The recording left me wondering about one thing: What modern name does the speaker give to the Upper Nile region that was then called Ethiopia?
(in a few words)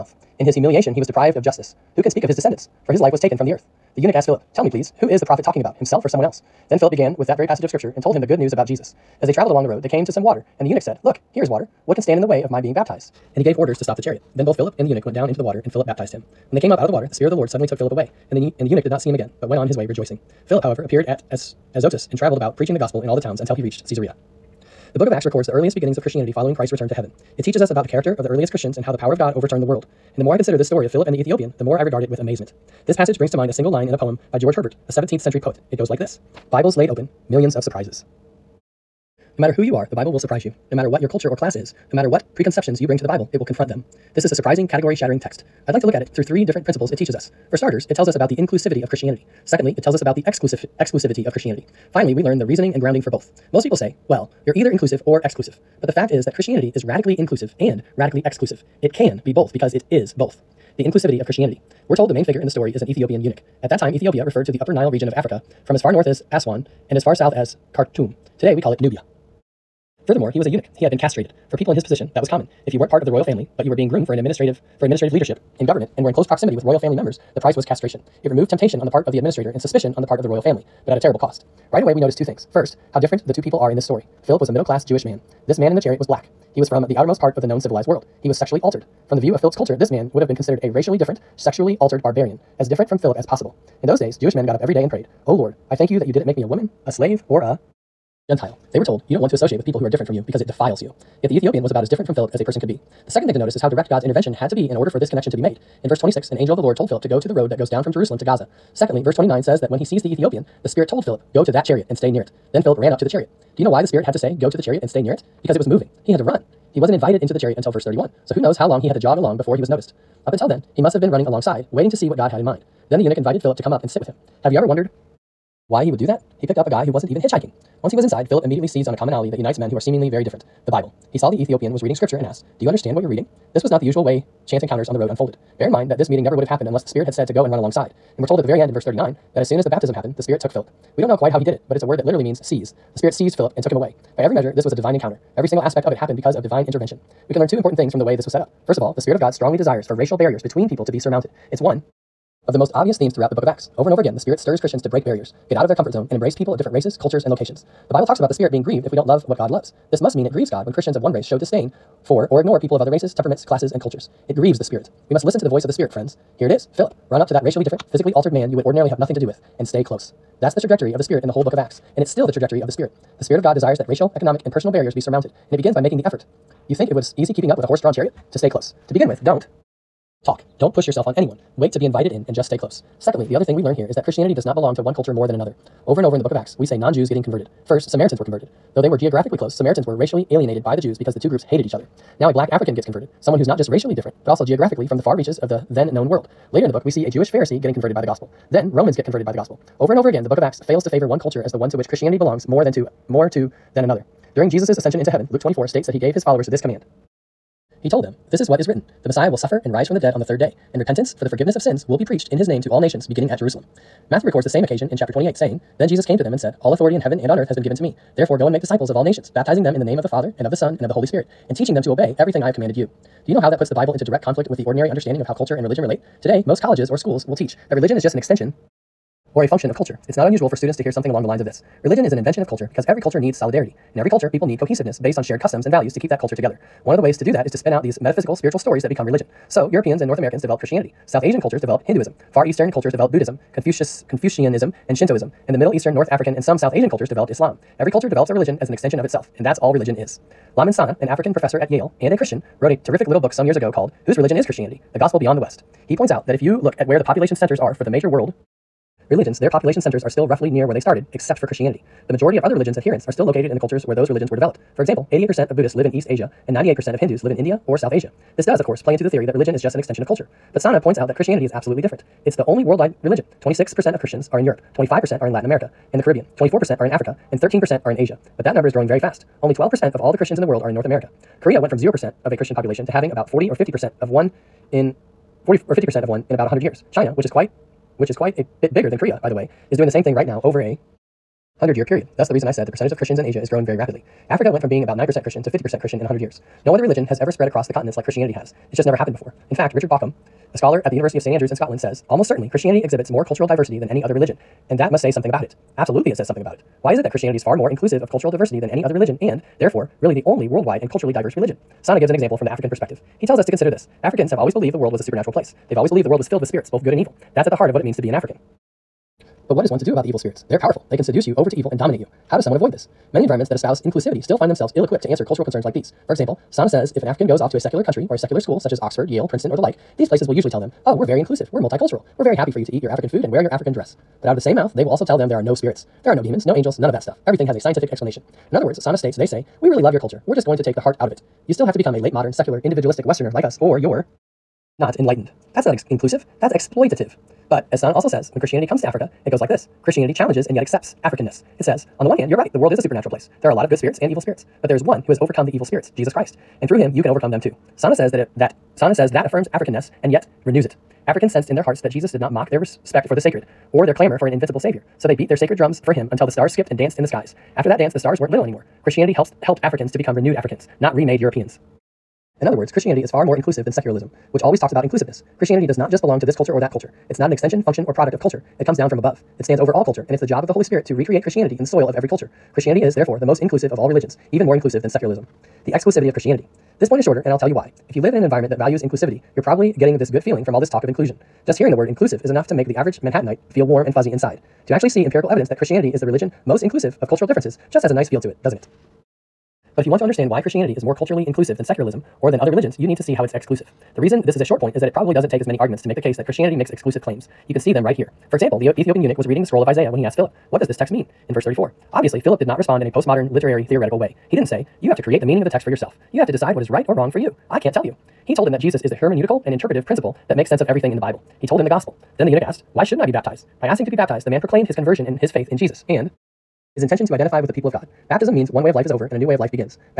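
Nubia.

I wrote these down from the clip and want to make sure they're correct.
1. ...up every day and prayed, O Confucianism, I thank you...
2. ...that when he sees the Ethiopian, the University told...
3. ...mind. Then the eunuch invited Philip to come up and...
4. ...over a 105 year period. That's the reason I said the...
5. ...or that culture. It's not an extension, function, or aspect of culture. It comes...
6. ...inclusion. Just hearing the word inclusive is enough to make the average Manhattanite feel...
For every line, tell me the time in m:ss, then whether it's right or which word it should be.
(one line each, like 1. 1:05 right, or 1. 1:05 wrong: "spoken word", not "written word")
1. 1:34 wrong: "Lord", not "Confucianism"
2. 1:49 wrong: "Spirit", not "University"
3. 2:02 right
4. 4:50 wrong: "100", not "105"
5. 6:16 wrong: "product", not "aspect"
6. 6:30 right.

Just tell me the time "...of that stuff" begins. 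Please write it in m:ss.
5:36.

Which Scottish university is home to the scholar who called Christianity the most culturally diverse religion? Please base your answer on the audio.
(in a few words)
University of St Andrews.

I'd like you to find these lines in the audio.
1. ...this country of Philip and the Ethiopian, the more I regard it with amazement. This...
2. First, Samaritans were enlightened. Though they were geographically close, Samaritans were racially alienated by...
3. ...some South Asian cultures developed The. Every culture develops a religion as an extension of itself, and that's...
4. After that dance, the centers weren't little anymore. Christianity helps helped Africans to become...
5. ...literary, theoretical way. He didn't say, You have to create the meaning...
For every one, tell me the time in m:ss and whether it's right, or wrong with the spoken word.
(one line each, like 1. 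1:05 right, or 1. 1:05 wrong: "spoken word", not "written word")
1. 0:30 wrong: "story", not "country"
2. 3:07 wrong: "converted", not "enlightened"
3. 4:06 wrong: "Islam", not "The"
4. 6:07 wrong: "stars", not "centers"
5. 6:53 right.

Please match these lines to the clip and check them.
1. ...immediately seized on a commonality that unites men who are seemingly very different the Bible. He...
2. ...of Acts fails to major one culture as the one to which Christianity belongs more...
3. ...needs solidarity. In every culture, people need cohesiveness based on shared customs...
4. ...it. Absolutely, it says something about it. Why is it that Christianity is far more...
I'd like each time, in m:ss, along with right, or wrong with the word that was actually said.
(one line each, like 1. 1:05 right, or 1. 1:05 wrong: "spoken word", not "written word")
1. 2:08 right
2. 3:20 wrong: "favor", not "major"
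3. 3:53 right
4. 5:05 right.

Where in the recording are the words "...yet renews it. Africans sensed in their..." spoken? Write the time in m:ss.
6:00.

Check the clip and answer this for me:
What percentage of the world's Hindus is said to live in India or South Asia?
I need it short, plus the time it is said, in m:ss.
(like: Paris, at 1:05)
98%, at 4:26.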